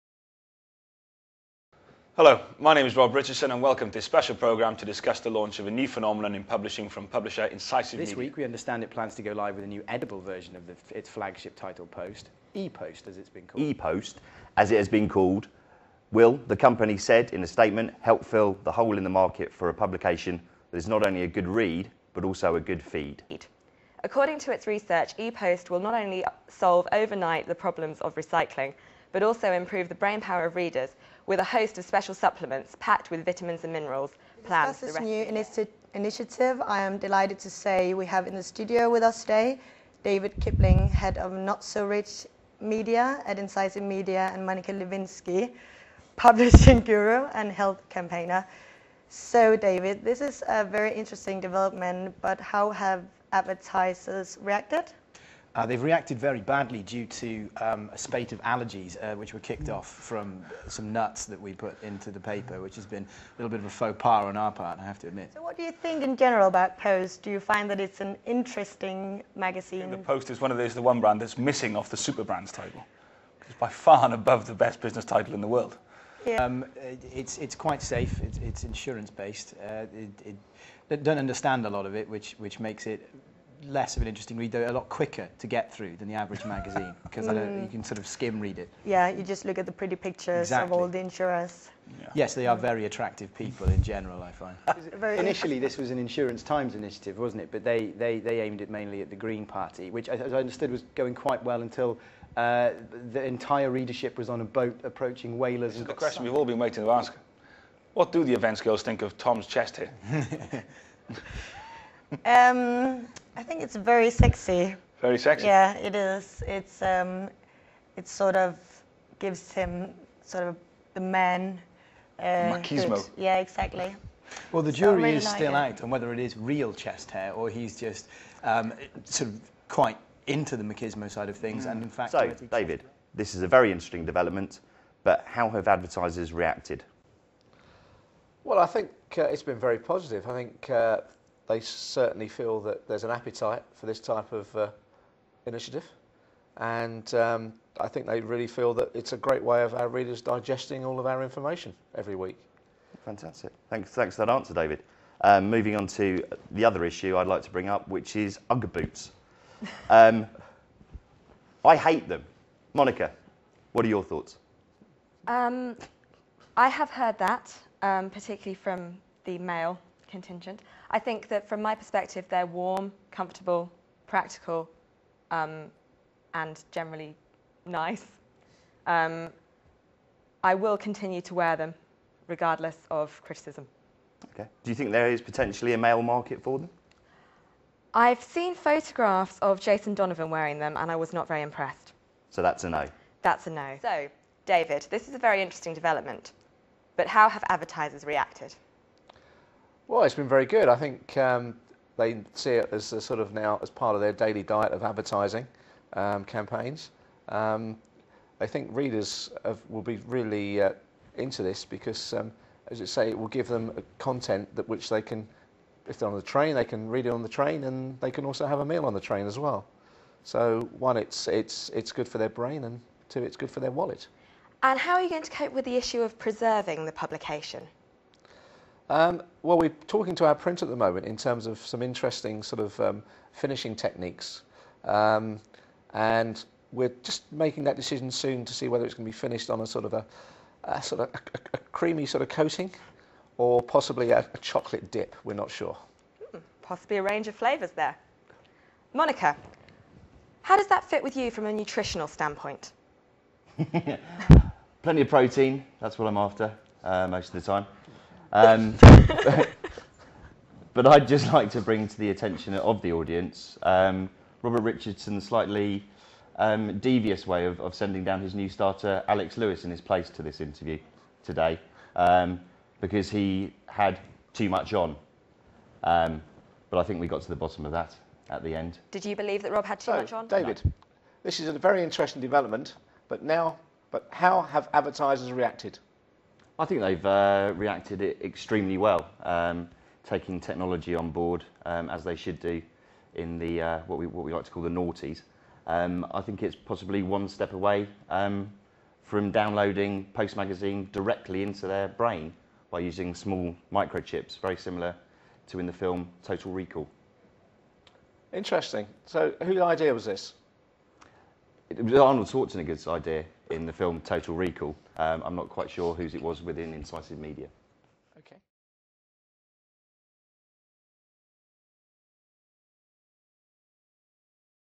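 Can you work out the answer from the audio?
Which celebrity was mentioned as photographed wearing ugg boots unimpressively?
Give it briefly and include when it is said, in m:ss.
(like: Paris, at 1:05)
Jason Donovan, at 3:09.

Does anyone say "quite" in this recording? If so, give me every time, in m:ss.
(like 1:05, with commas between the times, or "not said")
1:17, 1:41, 2:09, 5:15.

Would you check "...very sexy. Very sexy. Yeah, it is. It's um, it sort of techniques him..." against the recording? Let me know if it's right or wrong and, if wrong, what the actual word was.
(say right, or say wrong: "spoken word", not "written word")
wrong: "gives", not "techniques".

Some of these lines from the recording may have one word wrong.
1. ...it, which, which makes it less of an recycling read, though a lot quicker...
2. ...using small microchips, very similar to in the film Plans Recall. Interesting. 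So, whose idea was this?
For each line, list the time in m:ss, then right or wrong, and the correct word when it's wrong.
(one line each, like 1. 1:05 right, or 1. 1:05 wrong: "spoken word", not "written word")
1. 1:21 wrong: "interesting", not "recycling"
2. 5:02 wrong: "Total", not "Plans".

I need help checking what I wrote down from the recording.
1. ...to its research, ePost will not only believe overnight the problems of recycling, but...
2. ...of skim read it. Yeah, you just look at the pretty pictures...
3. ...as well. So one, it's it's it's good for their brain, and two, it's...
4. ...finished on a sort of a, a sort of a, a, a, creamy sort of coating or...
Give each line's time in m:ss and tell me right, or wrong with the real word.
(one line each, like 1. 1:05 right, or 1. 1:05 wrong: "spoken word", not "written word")
1. 0:24 wrong: "solve", not "believe"
2. 1:27 right
3. 3:39 right
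4. 3:59 right.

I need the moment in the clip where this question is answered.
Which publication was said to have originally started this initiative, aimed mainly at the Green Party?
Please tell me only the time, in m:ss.
1:35.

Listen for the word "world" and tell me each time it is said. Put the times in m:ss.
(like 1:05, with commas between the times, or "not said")
1:15.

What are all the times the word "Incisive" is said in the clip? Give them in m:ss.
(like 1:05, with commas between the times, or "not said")
0:07, 0:43, 5:16.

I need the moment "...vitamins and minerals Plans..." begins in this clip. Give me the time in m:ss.
0:33.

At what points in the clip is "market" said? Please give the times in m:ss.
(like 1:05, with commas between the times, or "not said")
0:19, 3:06.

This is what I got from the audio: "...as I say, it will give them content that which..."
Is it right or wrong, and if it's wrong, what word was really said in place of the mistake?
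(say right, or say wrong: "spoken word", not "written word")
right.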